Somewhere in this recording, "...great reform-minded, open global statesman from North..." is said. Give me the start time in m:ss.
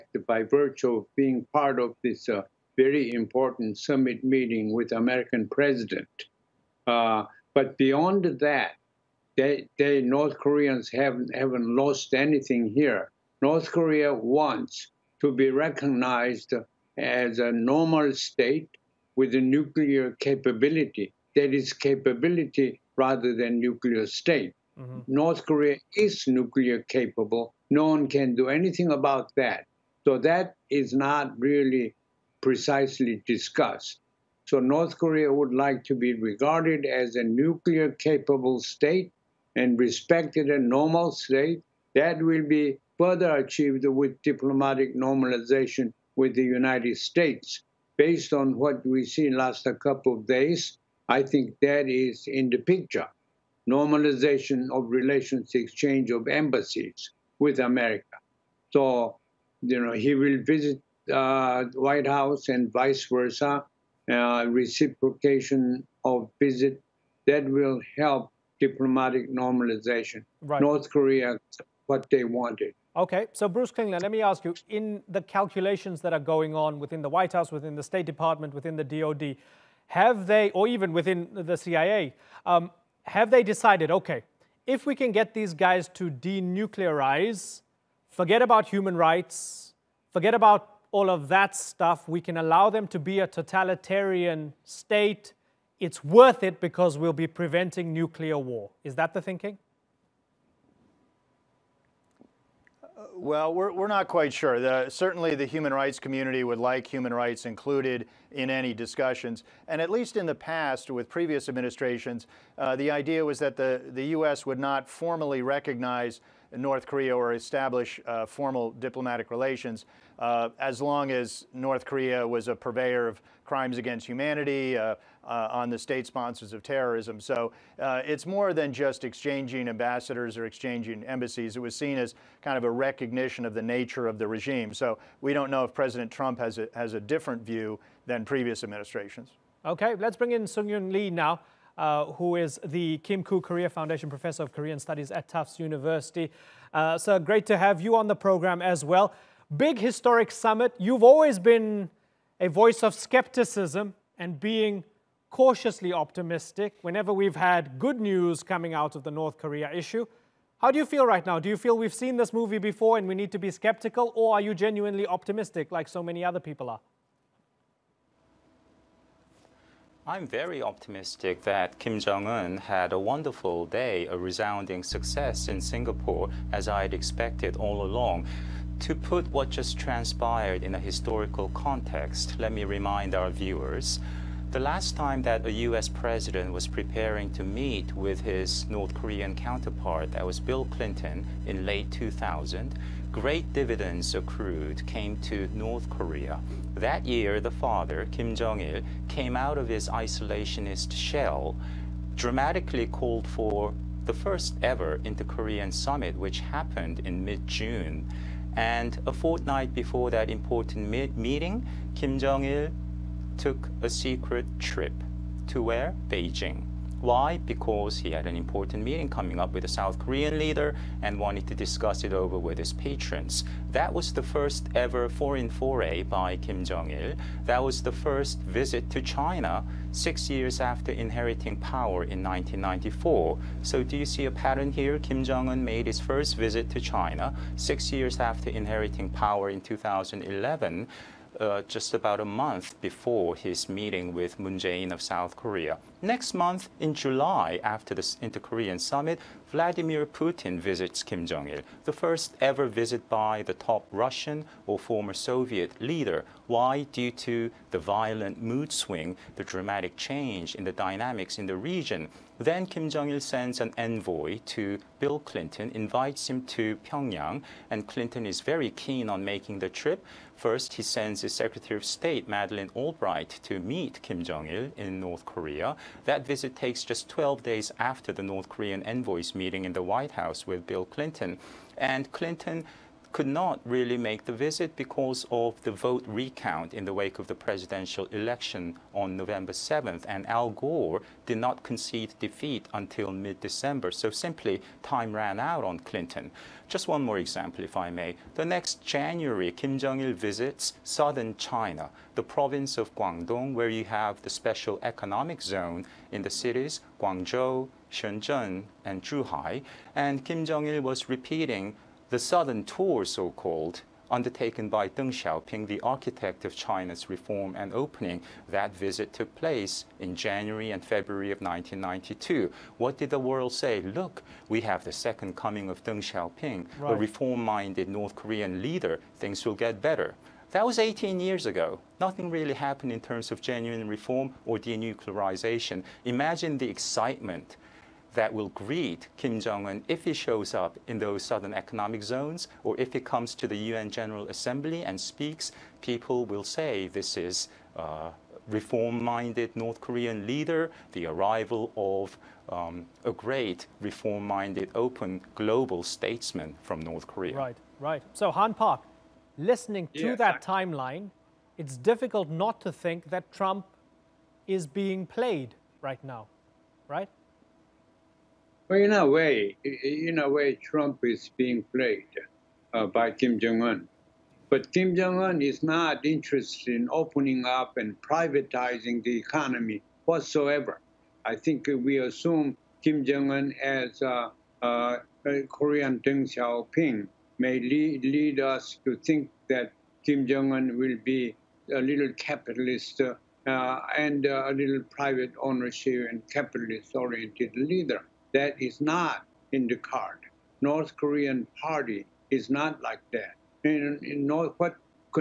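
5:53.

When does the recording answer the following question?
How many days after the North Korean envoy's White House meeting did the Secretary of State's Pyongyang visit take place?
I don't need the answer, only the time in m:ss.
4:37.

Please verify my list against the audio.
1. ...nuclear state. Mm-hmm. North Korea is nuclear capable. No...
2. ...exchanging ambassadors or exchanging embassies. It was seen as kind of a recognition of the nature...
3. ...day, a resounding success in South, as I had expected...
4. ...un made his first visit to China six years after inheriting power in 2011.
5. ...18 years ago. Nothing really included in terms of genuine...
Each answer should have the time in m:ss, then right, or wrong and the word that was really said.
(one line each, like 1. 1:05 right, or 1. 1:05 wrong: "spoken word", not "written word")
1. 0:23 right
2. 2:09 right
3. 2:53 wrong: "Singapore", not "South"
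4. 3:55 right
5. 5:30 wrong: "happened", not "included".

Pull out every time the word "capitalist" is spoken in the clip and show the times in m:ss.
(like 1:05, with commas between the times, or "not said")
6:32, 6:36.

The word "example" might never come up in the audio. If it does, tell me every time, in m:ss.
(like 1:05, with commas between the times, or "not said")
4:57.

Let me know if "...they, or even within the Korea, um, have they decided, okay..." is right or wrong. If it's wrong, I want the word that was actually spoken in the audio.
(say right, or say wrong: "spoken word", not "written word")
wrong: "CIA", not "Korea".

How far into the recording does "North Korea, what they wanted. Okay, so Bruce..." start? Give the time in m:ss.
1:10.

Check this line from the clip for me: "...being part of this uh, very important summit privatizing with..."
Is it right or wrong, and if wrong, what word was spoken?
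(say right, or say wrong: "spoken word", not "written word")
wrong: "meeting", not "privatizing".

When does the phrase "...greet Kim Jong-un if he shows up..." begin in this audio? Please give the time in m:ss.
5:38.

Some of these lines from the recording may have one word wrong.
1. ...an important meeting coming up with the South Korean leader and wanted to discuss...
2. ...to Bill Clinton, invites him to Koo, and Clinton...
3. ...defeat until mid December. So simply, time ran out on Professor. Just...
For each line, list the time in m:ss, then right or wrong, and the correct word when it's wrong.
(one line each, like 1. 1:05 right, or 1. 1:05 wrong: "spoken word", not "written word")
1. 3:38 right
2. 4:24 wrong: "Pyongyang", not "Koo"
3. 4:52 wrong: "Clinton", not "Professor".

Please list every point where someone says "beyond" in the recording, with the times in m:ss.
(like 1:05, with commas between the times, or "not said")
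0:07.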